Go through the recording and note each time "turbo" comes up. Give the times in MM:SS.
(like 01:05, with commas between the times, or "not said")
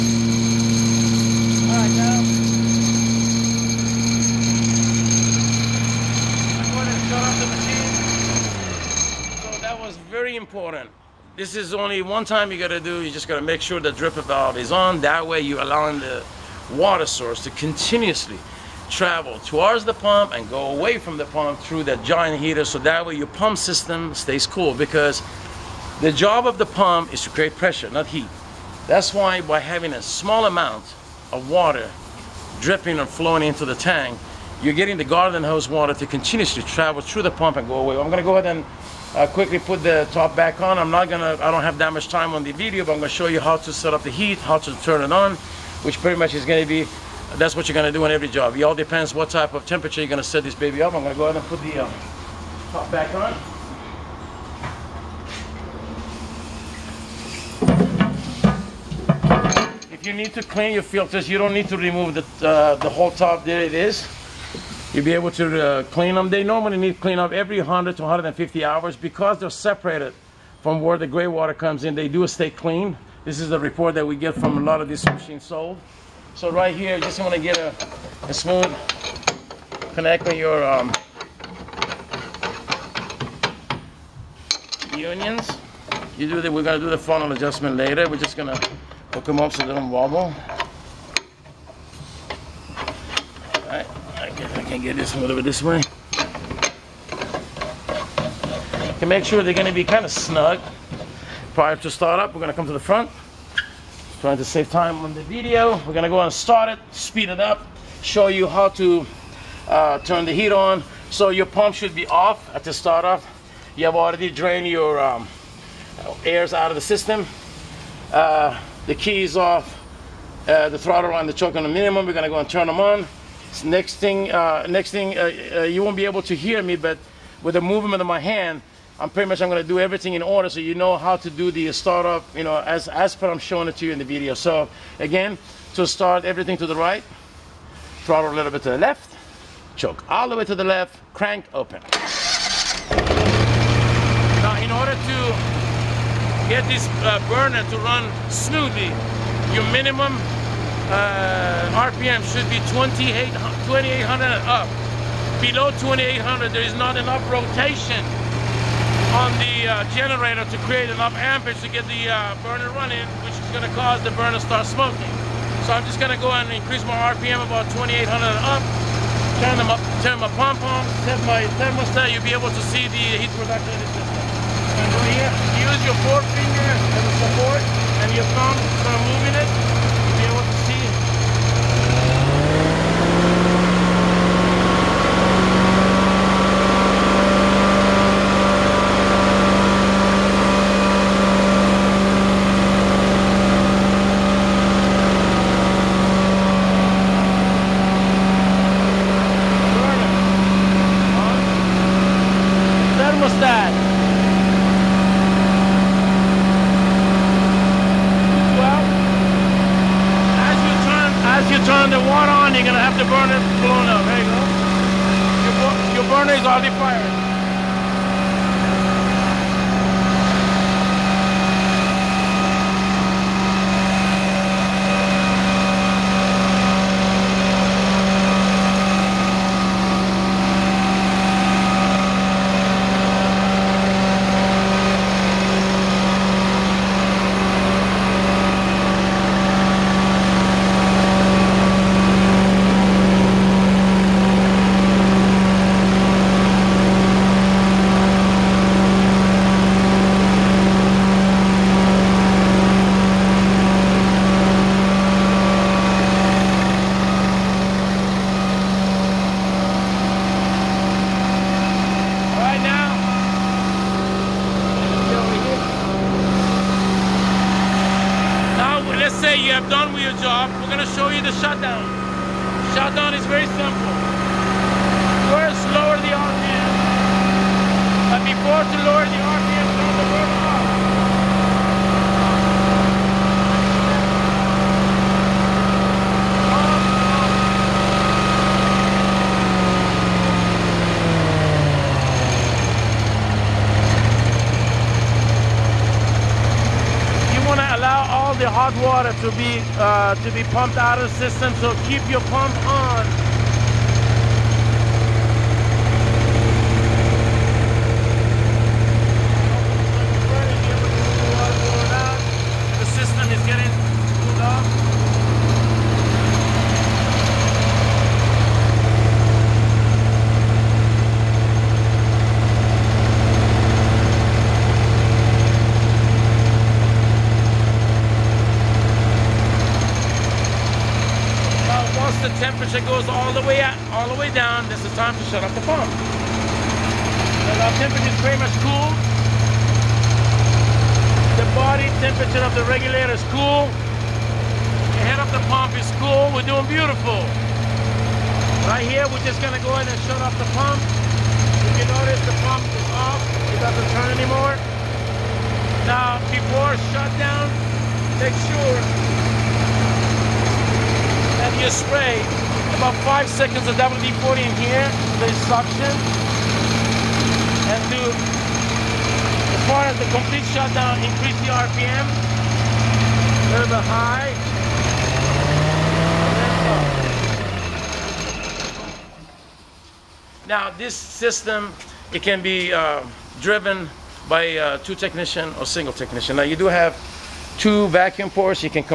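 not said.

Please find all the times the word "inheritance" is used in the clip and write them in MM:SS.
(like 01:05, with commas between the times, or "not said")
not said.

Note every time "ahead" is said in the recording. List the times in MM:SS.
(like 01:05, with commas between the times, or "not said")
00:38, 00:51, 05:49.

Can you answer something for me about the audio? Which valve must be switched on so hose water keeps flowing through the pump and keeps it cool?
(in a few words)
Dripper valve.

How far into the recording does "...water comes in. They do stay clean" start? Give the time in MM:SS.
01:11.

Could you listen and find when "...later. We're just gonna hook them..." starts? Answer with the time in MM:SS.
01:27.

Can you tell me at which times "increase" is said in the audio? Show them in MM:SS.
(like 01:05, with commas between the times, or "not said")
02:46, 06:10.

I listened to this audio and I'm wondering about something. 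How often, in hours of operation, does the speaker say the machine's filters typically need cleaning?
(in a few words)
100 to 150 hours.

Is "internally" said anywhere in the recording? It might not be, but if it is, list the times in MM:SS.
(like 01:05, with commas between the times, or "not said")
not said.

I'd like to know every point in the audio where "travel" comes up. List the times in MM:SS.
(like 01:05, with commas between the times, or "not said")
00:18, 00:36.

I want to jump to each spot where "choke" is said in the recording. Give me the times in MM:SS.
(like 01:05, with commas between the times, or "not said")
02:01, 02:19.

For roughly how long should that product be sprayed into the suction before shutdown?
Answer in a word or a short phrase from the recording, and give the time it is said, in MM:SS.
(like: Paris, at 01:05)
5 seconds, at 06:03.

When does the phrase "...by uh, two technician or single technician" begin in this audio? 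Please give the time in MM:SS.
06:24.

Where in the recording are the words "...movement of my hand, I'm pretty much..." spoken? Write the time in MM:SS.
02:07.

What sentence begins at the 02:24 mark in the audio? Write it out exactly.
Now in order to get this uh, burner to run smoothly, your minimum uh, RPM should be 2800 and up.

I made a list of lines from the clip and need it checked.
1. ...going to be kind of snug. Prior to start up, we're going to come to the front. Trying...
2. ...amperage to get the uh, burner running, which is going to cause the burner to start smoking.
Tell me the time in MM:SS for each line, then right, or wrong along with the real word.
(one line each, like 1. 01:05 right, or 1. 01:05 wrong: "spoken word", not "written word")
1. 01:39 right
2. 02:41 right.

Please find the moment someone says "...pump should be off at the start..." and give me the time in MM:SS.
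01:51.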